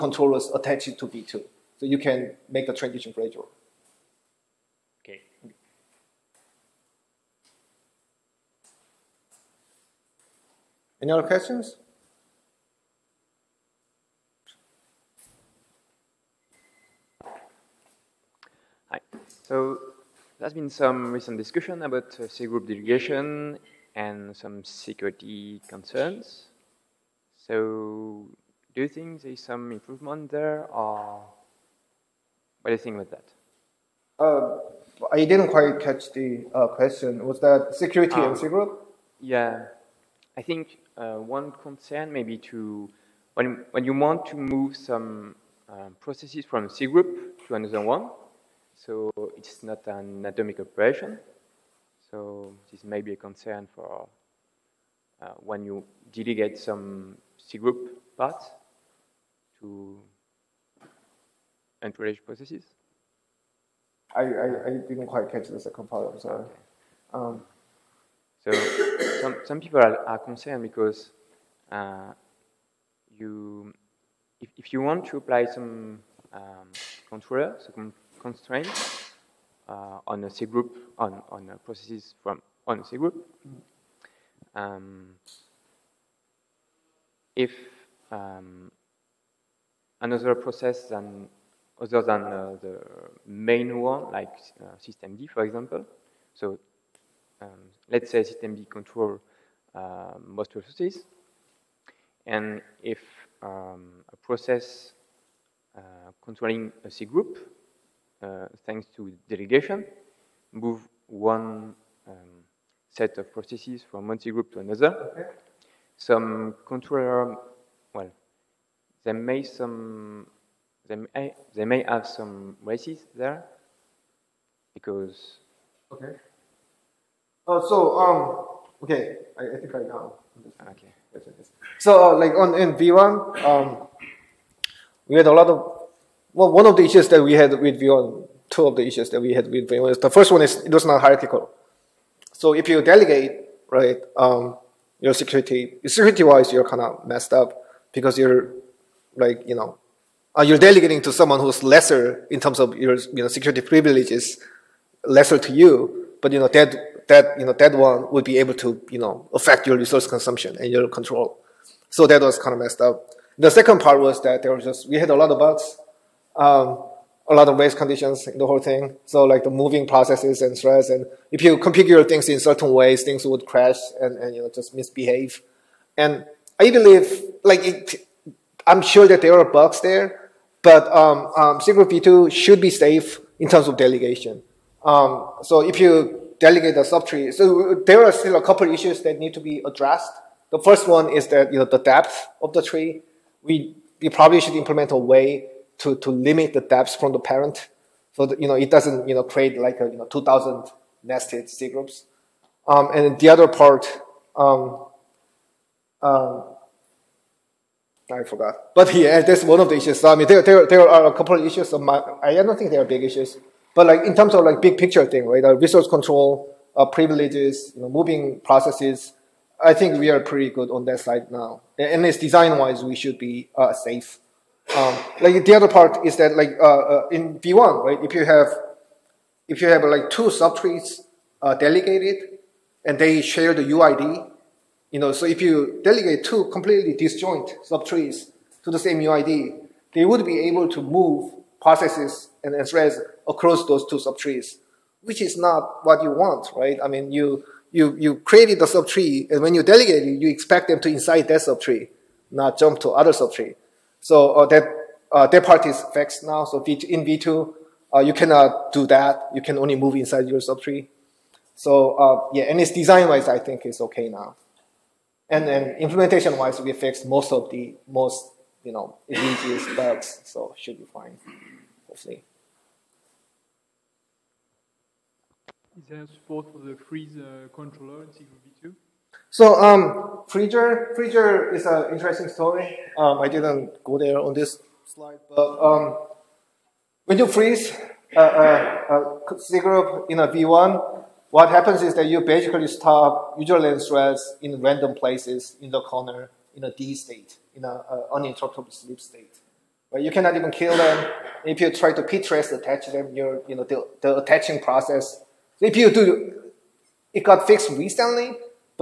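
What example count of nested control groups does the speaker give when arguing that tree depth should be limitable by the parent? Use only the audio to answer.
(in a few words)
2,000.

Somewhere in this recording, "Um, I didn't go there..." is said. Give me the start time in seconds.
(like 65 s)
282 s.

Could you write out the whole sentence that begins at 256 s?
So in V2, uh, you cannot do that.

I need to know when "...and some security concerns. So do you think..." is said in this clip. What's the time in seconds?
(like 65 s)
23 s.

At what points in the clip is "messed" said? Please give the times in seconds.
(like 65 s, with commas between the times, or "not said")
147 s, 162 s.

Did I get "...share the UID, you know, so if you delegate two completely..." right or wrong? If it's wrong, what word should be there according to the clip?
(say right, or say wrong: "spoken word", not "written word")
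right.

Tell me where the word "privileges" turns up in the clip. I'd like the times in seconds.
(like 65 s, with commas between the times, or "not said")
153 s, 216 s.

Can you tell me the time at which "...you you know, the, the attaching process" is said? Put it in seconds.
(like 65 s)
303 s.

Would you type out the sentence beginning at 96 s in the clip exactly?
So um, let's say system D control um, most processes.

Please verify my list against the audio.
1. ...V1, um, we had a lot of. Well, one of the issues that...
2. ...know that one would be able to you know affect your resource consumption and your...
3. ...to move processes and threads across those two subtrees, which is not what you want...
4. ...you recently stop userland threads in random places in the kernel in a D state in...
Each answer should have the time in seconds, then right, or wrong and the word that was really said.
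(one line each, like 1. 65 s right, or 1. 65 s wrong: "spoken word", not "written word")
1. 132 s right
2. 157 s right
3. 240 s right
4. 292 s wrong: "basically", not "recently".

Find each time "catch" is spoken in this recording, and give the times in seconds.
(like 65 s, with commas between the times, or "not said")
35 s, 65 s.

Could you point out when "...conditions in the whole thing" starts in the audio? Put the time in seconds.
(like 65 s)
167 s.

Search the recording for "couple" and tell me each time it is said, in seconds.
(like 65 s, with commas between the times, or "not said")
188 s, 211 s.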